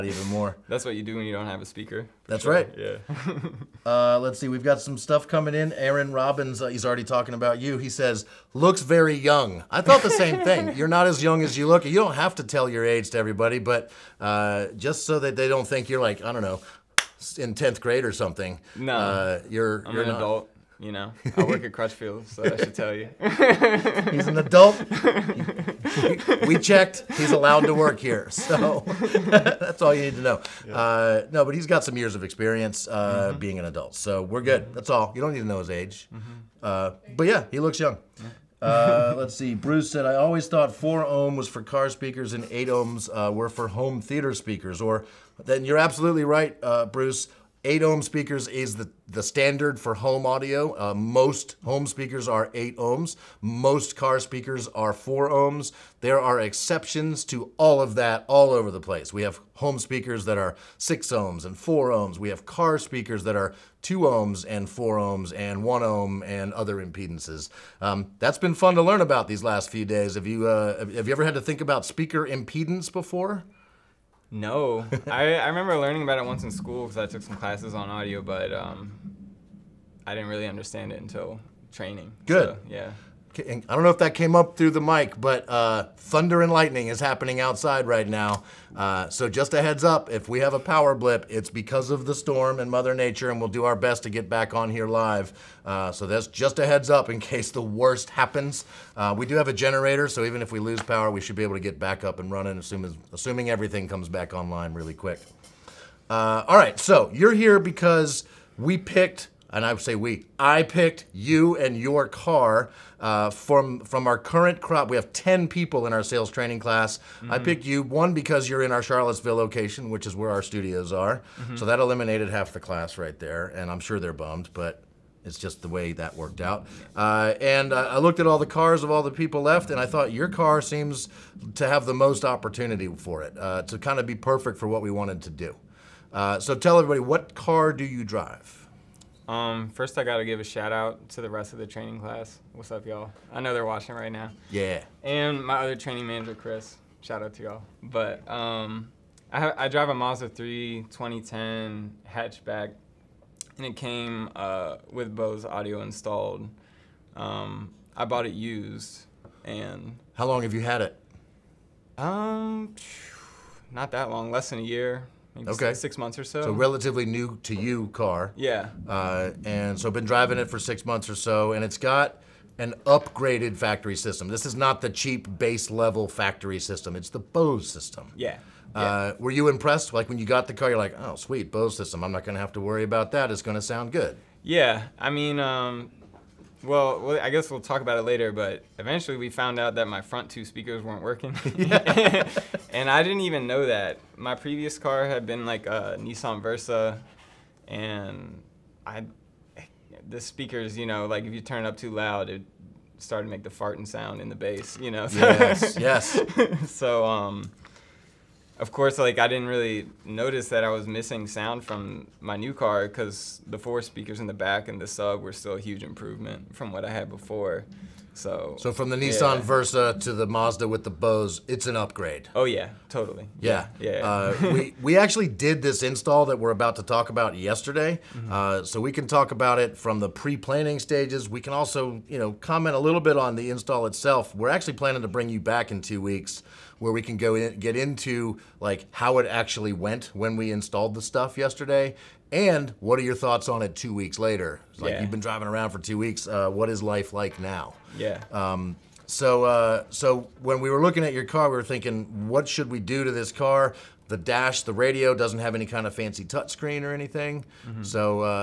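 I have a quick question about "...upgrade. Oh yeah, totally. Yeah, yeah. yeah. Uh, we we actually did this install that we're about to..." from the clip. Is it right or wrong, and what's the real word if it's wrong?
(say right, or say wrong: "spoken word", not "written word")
right.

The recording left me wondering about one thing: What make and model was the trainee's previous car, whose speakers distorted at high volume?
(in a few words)
Nissan Versa.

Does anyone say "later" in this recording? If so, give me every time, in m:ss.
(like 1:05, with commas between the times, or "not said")
3:08, 4:04.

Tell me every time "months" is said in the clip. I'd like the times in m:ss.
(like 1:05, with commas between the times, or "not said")
2:45, 2:50.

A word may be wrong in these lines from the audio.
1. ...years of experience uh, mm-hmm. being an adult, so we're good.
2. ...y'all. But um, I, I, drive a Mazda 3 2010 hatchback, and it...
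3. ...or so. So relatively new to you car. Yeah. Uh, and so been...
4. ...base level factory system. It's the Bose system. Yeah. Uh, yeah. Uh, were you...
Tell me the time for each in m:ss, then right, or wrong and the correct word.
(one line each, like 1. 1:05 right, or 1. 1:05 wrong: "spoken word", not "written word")
1. 0:31 right
2. 2:27 right
3. 2:46 right
4. 2:55 right.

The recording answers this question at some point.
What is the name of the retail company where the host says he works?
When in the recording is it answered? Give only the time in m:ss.
0:21.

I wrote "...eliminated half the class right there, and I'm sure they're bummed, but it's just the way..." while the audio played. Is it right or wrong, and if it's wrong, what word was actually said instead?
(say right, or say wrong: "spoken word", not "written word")
right.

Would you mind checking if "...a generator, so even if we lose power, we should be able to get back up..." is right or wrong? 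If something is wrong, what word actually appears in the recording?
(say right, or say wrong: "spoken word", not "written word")
right.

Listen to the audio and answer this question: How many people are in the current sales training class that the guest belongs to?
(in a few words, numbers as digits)
10.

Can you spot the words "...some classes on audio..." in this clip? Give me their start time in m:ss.
1:17.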